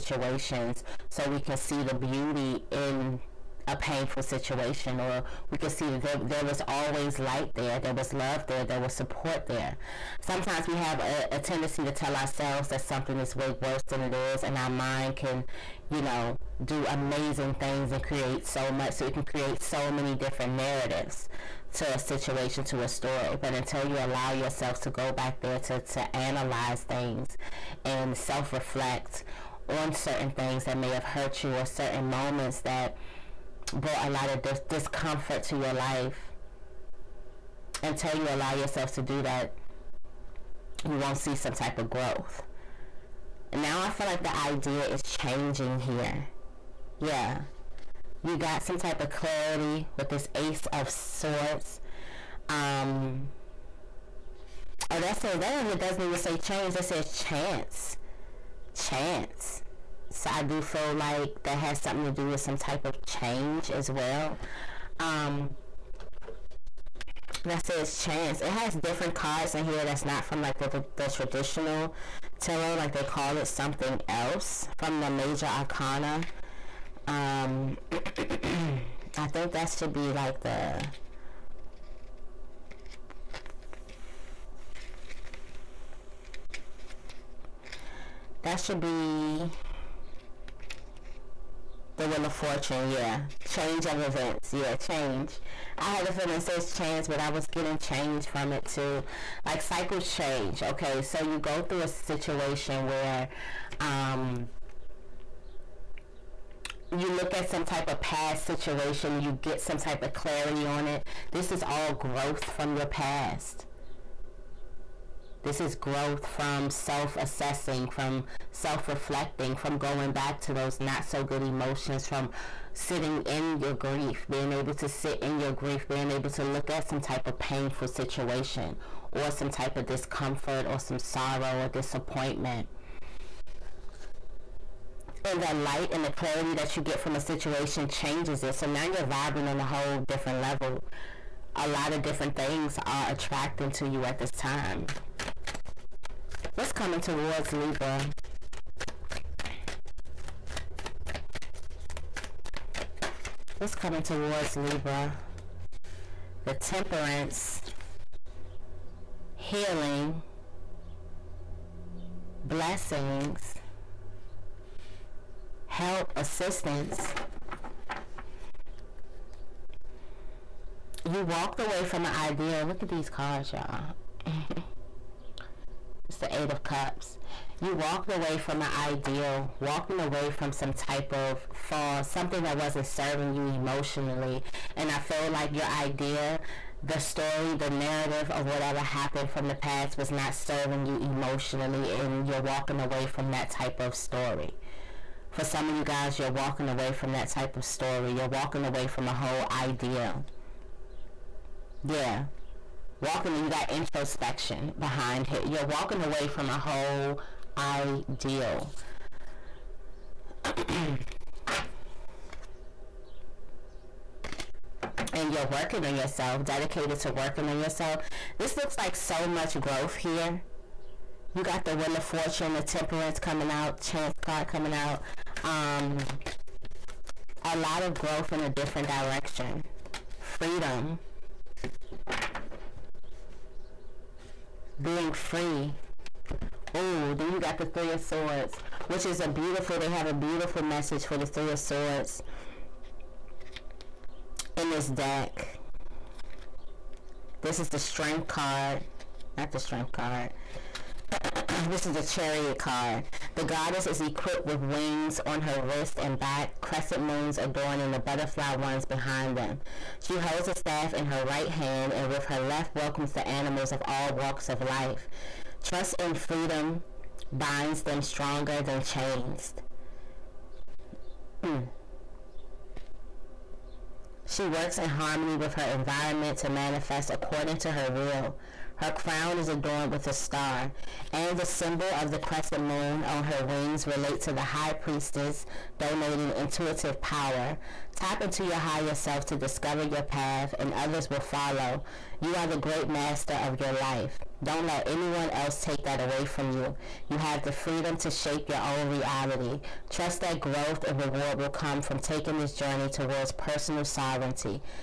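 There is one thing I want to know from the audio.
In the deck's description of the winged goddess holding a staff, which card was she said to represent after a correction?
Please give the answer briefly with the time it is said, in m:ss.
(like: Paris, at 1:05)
The Chariot, at 4:11.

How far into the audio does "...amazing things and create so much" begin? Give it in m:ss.
0:16.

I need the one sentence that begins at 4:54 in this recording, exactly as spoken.
Don't let anyone else take that away from you.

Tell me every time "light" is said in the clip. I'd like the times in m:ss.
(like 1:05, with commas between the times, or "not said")
0:07, 2:15.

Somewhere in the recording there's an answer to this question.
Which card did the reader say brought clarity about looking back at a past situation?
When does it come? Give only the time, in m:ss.
0:50.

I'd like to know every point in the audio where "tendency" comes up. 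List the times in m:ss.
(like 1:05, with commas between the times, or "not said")
0:11.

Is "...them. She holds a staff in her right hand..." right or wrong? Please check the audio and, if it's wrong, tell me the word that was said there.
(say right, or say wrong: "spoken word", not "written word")
right.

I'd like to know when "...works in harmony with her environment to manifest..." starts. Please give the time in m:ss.
4:34.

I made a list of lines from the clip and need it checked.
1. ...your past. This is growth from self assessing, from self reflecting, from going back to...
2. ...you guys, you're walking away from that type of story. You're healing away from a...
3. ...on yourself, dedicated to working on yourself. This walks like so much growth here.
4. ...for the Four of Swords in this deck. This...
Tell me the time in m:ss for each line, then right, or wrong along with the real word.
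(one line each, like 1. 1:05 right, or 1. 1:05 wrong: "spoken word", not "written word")
1. 1:52 right
2. 3:15 wrong: "walking", not "healing"
3. 3:35 wrong: "looks", not "walks"
4. 4:01 wrong: "Three", not "Four".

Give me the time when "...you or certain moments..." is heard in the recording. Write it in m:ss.
0:31.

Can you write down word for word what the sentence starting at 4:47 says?
Tap into your higher self to discover your path, and others will follow.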